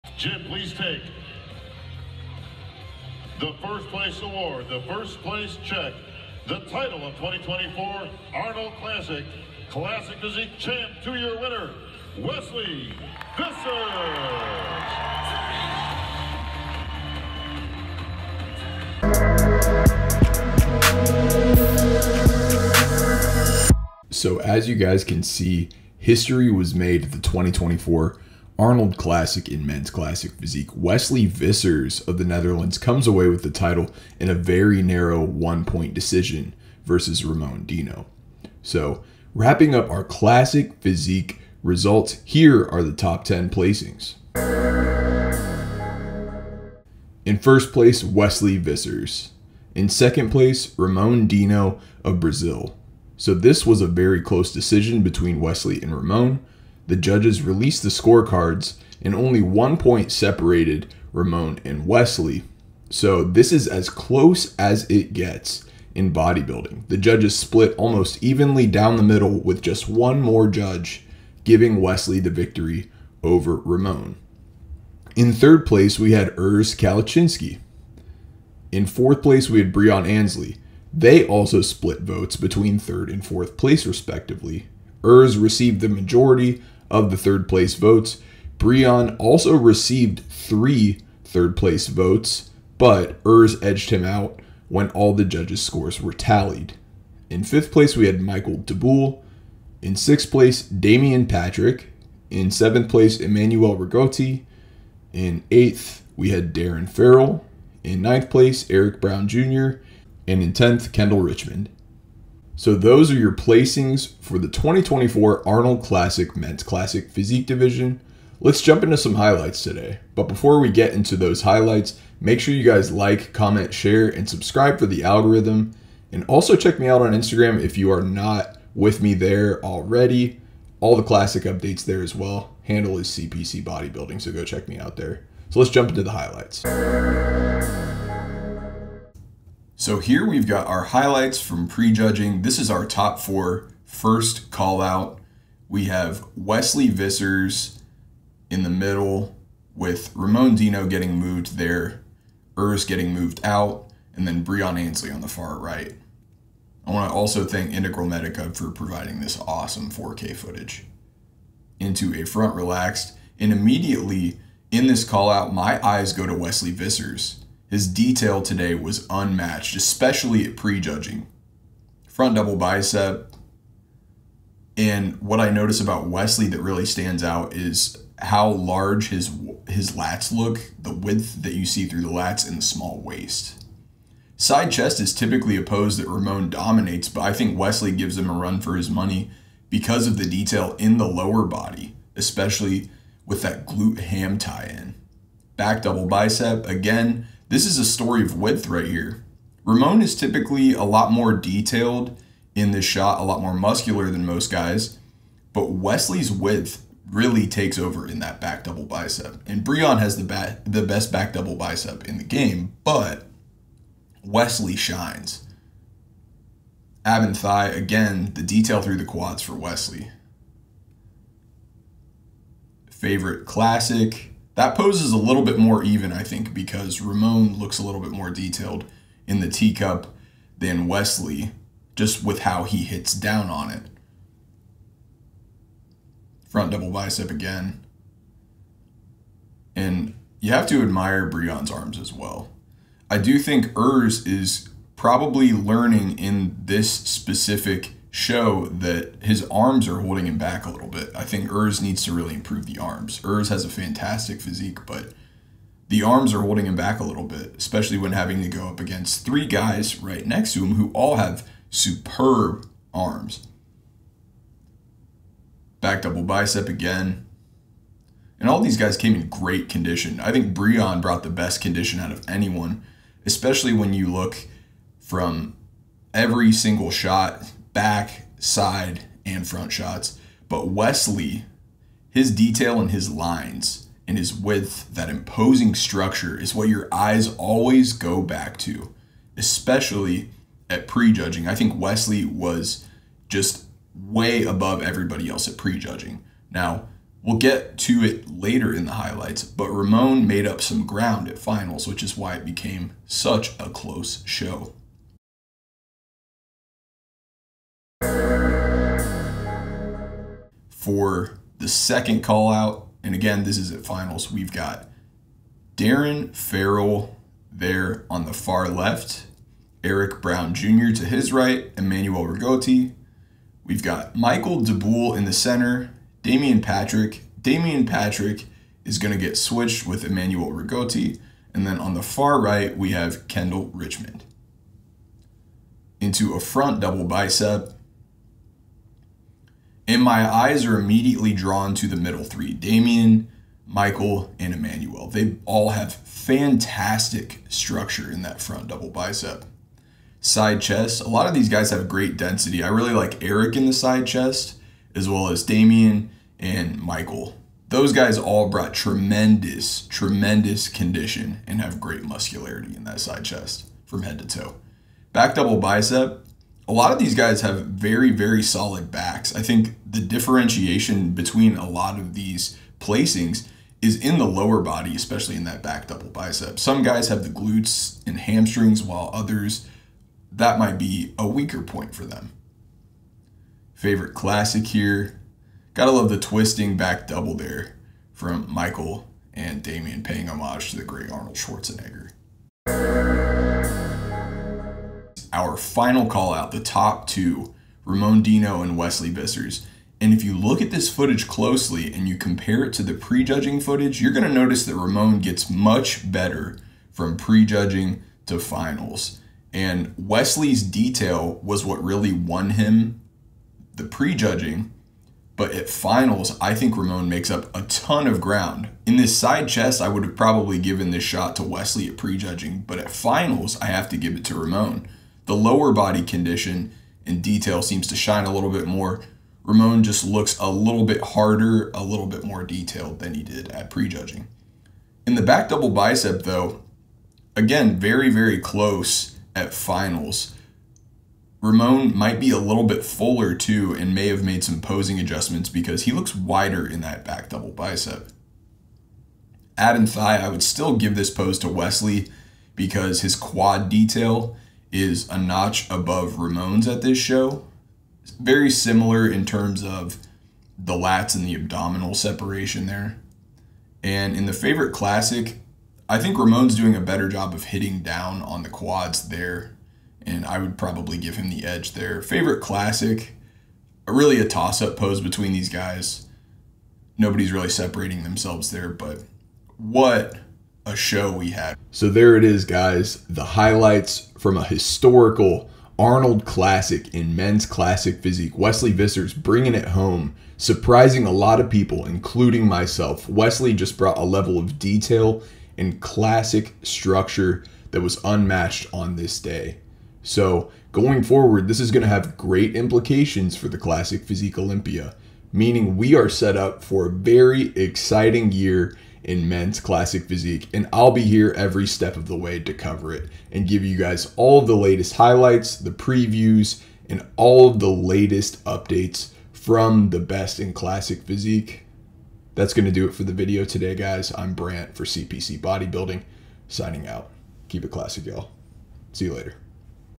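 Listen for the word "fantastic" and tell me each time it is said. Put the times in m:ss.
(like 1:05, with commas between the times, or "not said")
4:13, 5:45.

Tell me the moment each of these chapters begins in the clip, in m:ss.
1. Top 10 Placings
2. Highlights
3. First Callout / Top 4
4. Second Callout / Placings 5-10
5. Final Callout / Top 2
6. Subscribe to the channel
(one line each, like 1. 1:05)
1. 0:45
2. 1:58
3. 2:15
4. 5:10
5. 6:30
6. 8:01.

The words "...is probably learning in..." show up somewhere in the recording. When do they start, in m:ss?
4:04.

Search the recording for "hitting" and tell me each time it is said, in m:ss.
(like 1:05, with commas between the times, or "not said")
7:47.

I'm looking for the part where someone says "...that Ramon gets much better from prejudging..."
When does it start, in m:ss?
6:44.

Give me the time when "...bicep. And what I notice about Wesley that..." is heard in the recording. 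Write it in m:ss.
2:52.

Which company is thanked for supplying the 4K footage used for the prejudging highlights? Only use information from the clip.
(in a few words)
Integral Medica.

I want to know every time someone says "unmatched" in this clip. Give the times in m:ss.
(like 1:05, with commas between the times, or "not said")
2:49, 8:18.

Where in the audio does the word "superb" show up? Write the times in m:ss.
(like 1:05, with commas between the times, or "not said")
4:21.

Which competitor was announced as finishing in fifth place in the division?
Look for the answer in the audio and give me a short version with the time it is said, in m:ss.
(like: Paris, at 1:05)
Michael Taboul, at 1:38.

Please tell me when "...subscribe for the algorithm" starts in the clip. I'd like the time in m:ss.
2:04.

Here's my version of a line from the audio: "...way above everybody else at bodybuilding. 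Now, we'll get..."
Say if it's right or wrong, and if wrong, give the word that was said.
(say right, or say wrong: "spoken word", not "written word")
wrong: "prejudging", not "bodybuilding".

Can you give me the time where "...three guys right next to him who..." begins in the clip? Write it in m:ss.
4:19.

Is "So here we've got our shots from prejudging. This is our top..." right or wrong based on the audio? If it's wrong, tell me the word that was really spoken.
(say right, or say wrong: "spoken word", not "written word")
wrong: "highlights", not "shots".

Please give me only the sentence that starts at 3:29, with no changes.
And Breon has the, bat, the best back double bicep in the game, but Wesley shines.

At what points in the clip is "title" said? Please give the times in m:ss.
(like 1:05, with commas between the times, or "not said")
0:06, 0:33.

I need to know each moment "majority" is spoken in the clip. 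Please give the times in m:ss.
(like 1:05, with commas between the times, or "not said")
1:25.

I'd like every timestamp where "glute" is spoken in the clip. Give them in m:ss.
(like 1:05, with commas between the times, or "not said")
3:13, 6:17.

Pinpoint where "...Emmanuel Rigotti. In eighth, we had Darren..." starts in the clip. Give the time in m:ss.
1:43.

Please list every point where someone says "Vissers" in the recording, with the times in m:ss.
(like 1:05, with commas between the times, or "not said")
0:13, 0:31, 0:48, 2:26, 2:46, 6:39, 8:08.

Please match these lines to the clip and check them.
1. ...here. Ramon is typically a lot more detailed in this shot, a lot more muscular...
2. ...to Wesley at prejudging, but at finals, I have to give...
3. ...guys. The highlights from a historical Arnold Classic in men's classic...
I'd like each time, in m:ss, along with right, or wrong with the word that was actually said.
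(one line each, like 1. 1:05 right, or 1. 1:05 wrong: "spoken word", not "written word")
1. 3:18 right
2. 7:01 right
3. 8:02 right.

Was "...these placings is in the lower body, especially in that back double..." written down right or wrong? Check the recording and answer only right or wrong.
right.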